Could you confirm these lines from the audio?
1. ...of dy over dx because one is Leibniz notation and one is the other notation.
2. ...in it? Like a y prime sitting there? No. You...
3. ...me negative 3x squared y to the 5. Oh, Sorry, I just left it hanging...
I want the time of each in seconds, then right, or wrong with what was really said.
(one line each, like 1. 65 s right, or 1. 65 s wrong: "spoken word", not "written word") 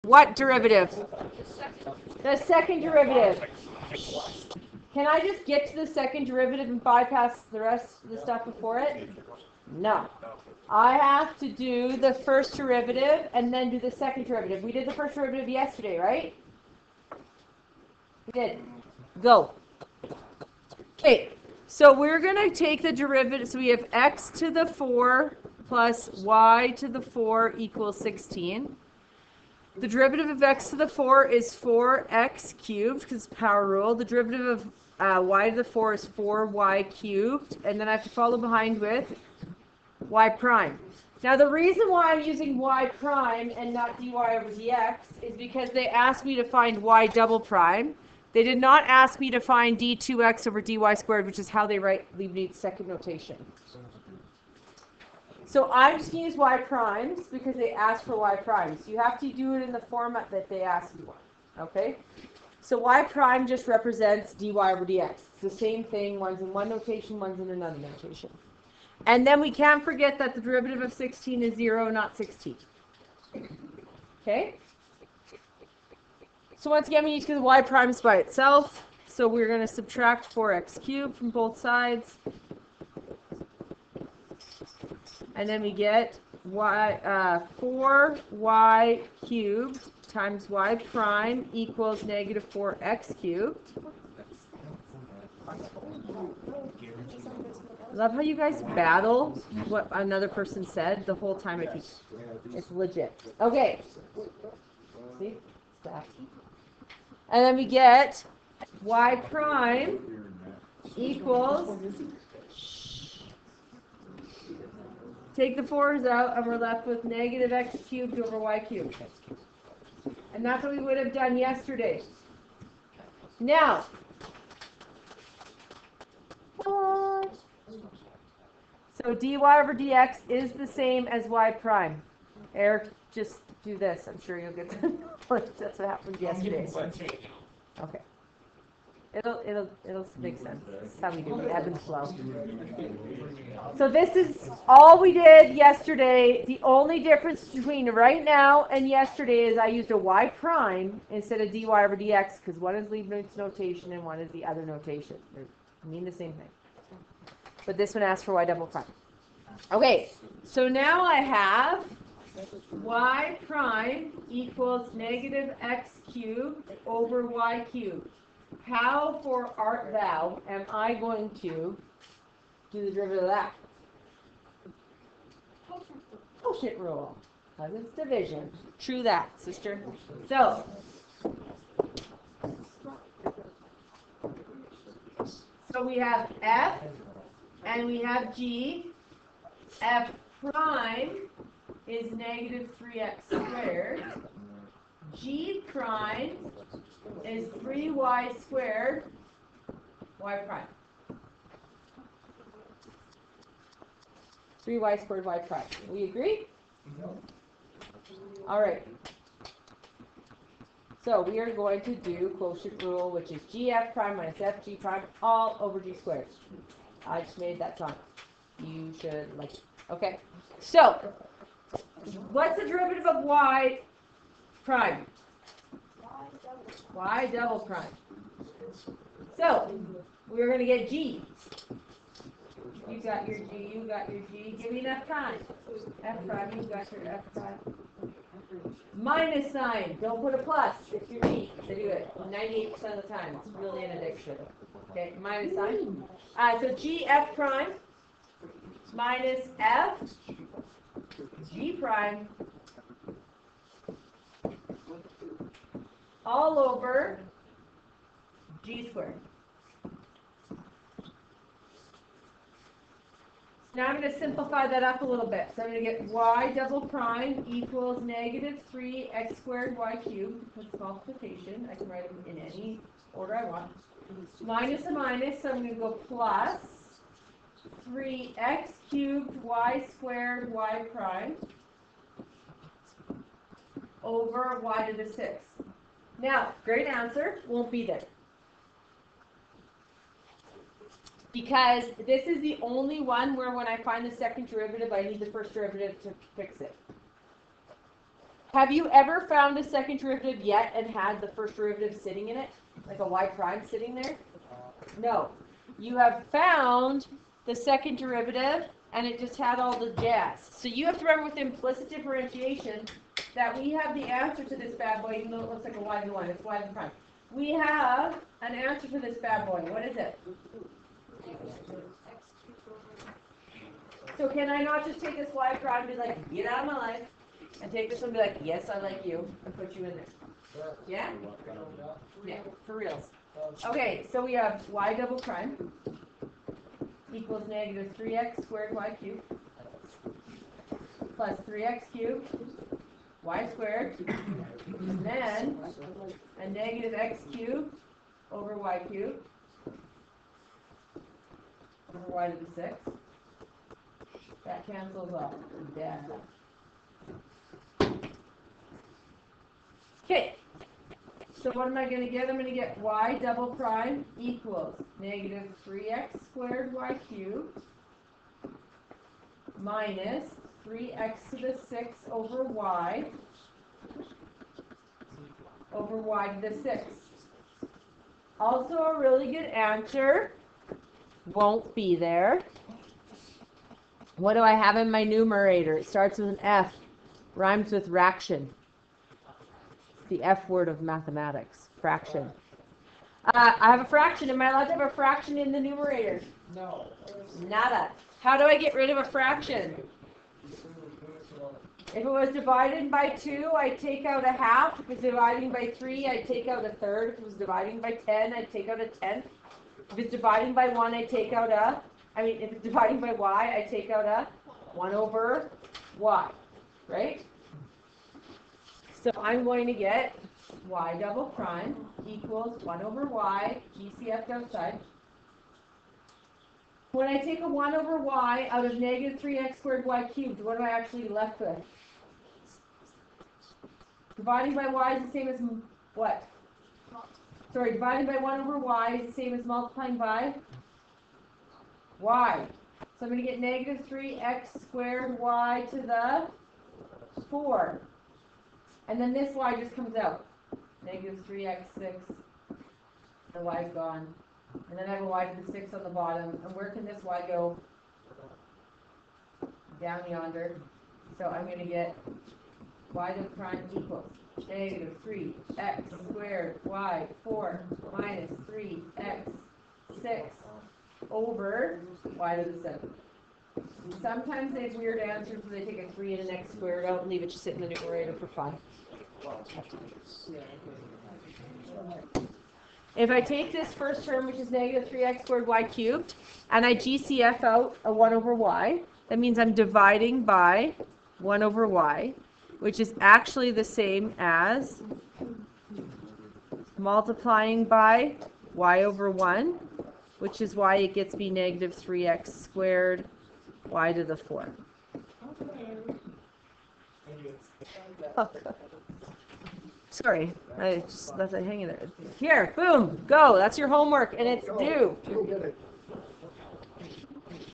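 1. 151 s right
2. 302 s right
3. 501 s wrong: "4", not "5".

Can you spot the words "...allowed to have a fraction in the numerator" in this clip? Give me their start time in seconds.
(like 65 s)
394 s.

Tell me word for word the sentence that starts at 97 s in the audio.
Love how you guys battle what another person said the whole time.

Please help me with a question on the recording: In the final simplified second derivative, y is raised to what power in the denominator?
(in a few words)
7.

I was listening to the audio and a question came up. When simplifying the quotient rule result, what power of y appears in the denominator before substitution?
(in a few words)
6.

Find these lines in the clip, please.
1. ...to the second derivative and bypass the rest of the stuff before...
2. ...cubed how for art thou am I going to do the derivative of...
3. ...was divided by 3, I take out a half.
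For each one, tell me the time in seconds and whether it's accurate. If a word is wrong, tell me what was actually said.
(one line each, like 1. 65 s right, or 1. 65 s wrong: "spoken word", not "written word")
1. 5 s right
2. 167 s right
3. 402 s wrong: "2", not "3".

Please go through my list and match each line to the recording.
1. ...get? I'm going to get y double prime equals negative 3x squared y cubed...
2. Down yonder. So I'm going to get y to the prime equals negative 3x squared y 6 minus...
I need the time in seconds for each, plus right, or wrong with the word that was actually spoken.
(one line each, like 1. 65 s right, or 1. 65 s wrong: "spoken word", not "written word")
1. 362 s right
2. 459 s wrong: "4", not "6".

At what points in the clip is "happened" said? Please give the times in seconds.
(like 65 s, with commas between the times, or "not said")
135 s.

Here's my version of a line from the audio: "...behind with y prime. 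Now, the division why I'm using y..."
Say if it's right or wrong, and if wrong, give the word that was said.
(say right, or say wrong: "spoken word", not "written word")
wrong: "reason", not "division".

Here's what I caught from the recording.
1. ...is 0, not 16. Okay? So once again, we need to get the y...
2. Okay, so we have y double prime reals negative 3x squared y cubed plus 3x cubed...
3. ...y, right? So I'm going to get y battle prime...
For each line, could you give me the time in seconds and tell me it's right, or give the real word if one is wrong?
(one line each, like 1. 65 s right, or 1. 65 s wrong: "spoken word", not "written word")
1. 71 s right
2. 333 s wrong: "equals", not "reals"
3. 415 s wrong: "double", not "battle".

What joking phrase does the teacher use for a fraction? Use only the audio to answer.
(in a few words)
the F word of mathematics.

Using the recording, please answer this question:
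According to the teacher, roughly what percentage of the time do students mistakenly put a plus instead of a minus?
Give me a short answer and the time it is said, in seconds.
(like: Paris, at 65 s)
98%, at 242 s.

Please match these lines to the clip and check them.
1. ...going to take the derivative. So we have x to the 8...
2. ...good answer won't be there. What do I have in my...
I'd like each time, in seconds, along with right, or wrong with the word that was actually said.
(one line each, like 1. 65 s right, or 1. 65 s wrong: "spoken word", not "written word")
1. 22 s wrong: "4", not "8"
2. 379 s right.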